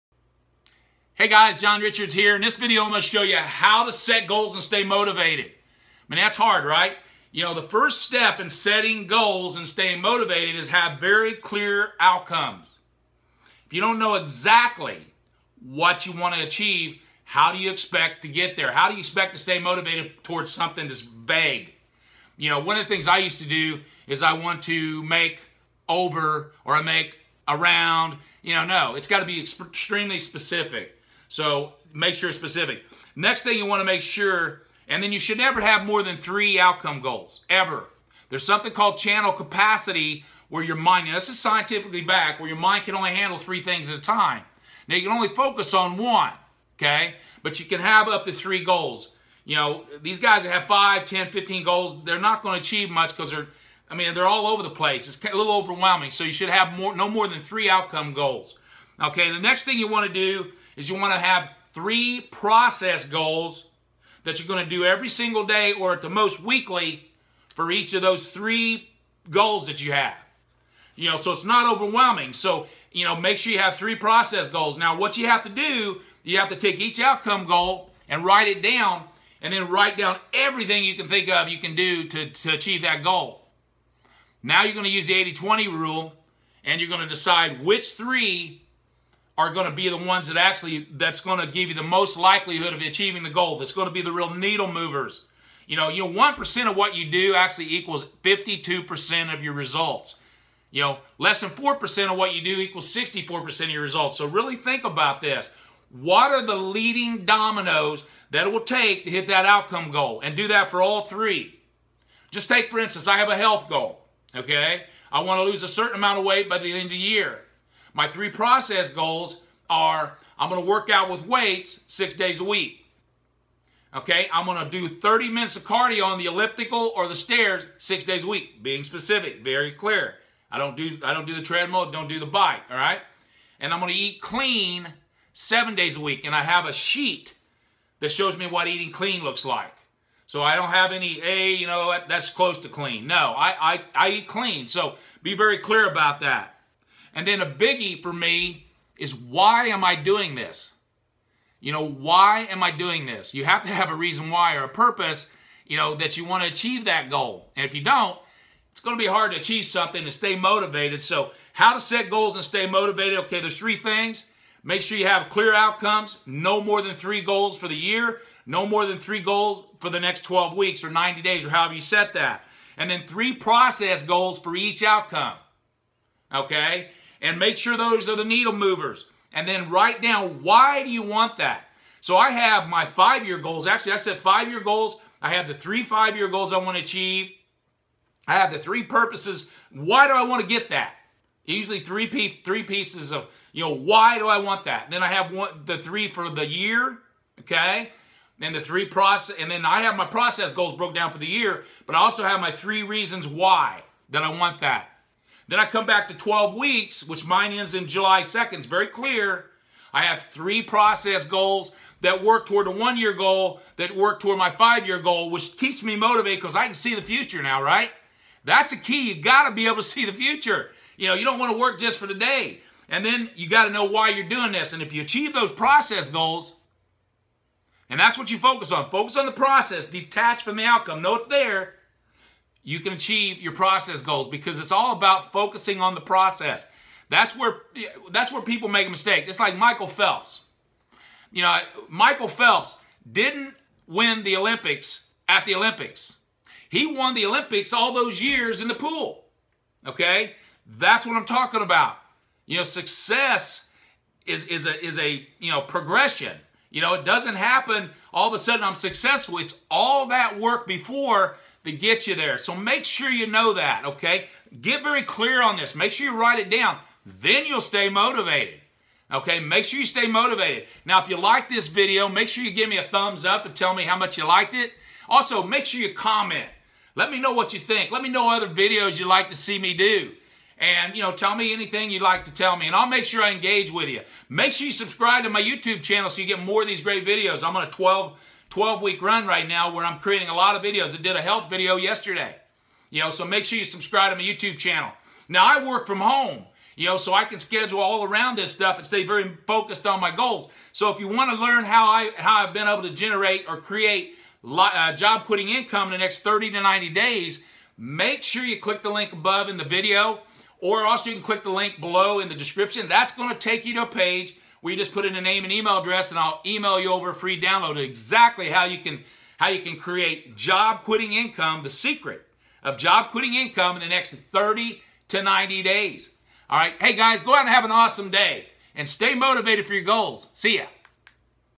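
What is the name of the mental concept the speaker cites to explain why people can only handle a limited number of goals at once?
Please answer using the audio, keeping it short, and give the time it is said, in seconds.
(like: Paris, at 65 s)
channel capacity, at 38 s.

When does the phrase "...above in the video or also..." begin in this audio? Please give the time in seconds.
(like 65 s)
309 s.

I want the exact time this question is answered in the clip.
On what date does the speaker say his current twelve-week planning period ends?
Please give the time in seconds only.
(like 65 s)
207 s.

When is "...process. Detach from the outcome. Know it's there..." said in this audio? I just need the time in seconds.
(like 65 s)
229 s.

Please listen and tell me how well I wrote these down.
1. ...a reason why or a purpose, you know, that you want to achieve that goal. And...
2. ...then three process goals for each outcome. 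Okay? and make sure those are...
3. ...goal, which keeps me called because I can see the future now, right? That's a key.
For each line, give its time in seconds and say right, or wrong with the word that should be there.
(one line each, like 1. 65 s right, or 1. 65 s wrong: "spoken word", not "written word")
1. 153 s right
2. 172 s right
3. 214 s wrong: "motivated", not "called".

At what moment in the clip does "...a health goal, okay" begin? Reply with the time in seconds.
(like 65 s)
113 s.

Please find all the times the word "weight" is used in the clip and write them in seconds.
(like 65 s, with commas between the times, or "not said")
116 s, 121 s.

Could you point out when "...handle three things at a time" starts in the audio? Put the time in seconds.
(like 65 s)
43 s.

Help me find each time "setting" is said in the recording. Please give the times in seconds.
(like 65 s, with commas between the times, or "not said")
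8 s.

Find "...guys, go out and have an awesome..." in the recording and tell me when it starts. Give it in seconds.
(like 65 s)
326 s.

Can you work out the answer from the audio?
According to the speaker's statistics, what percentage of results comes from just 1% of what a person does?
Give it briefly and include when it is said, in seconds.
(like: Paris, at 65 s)
52%, at 98 s.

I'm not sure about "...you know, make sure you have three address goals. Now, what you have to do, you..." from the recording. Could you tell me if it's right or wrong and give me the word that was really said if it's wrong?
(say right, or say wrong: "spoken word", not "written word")
wrong: "process", not "address".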